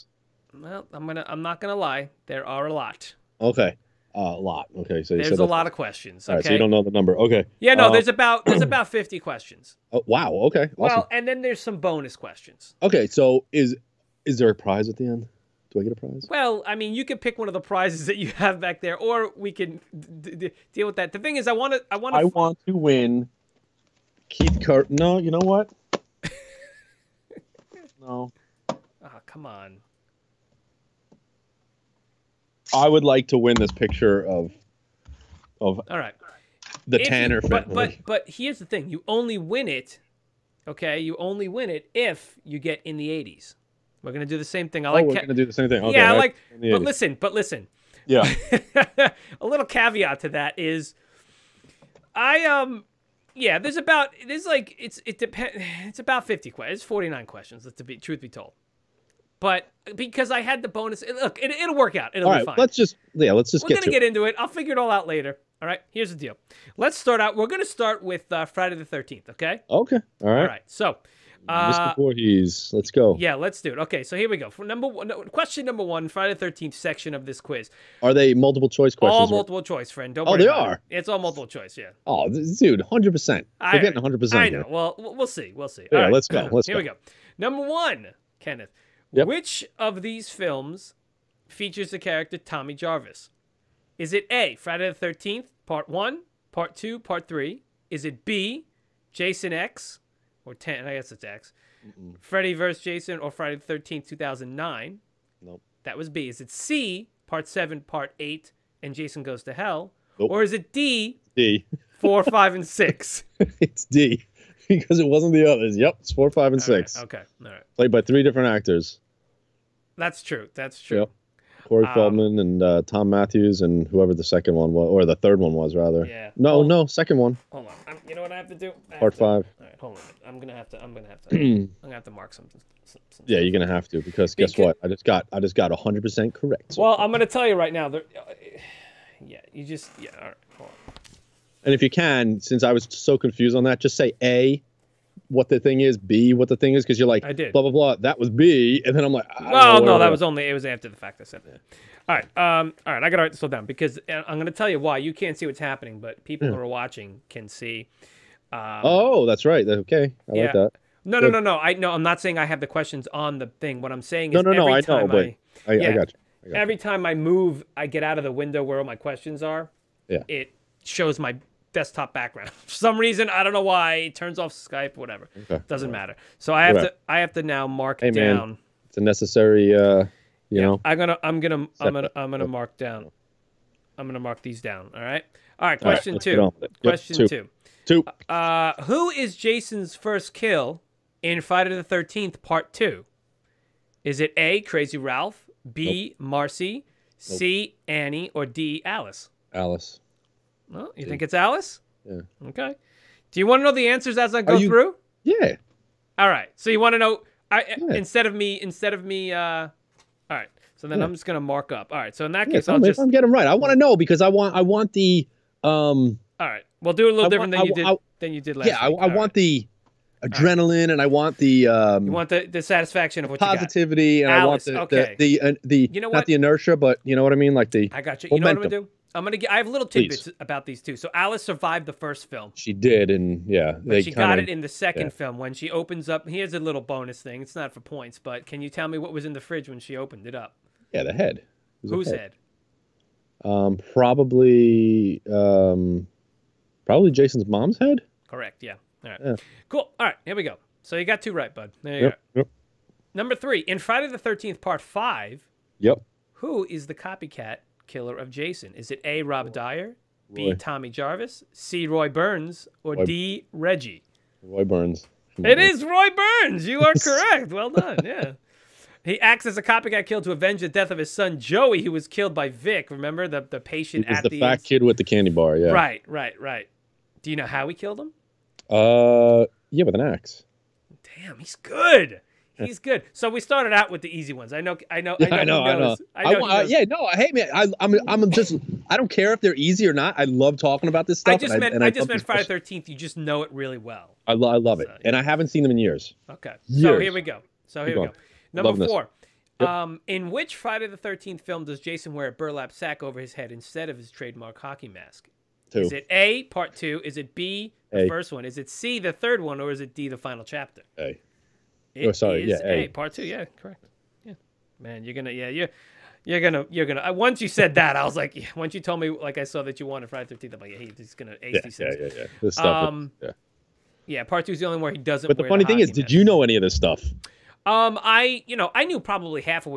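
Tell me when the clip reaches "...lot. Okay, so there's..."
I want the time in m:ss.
0:04.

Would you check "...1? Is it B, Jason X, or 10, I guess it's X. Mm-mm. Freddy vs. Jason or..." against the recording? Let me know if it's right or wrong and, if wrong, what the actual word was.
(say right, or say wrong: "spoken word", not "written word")
wrong: "3", not "1".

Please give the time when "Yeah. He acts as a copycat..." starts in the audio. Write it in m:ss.
4:28.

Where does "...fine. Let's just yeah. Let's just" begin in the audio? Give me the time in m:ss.
1:02.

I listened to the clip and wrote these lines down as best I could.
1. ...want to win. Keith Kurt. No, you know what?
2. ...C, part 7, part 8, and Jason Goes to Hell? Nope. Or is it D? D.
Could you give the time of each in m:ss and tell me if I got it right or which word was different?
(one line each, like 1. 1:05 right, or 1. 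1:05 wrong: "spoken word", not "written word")
1. 0:22 right
2. 1:46 right.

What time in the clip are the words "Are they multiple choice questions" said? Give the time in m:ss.
1:18.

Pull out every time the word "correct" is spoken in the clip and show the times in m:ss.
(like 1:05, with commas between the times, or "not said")
2:16, 4:08, 4:26, 5:13.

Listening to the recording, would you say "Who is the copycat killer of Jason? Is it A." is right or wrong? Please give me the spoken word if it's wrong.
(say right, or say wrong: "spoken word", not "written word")
right.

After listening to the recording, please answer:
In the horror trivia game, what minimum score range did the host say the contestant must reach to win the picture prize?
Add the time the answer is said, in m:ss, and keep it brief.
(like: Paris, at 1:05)
the 80s, at 0:42.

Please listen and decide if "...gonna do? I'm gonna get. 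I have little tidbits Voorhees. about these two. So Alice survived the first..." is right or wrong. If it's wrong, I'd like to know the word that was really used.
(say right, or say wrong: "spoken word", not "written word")
wrong: "Please", not "Voorhees".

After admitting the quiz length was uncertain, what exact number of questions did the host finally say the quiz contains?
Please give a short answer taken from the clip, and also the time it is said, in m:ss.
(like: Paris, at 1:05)
49, at 0:56.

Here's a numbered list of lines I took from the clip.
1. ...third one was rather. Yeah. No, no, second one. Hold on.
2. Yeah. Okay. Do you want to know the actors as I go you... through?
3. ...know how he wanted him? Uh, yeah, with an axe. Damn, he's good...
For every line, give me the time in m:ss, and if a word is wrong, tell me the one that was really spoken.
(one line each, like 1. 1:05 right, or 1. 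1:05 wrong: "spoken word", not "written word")
1. 2:05 right
2. 3:22 wrong: "answers", not "actors"
3. 4:37 wrong: "killed", not "wanted".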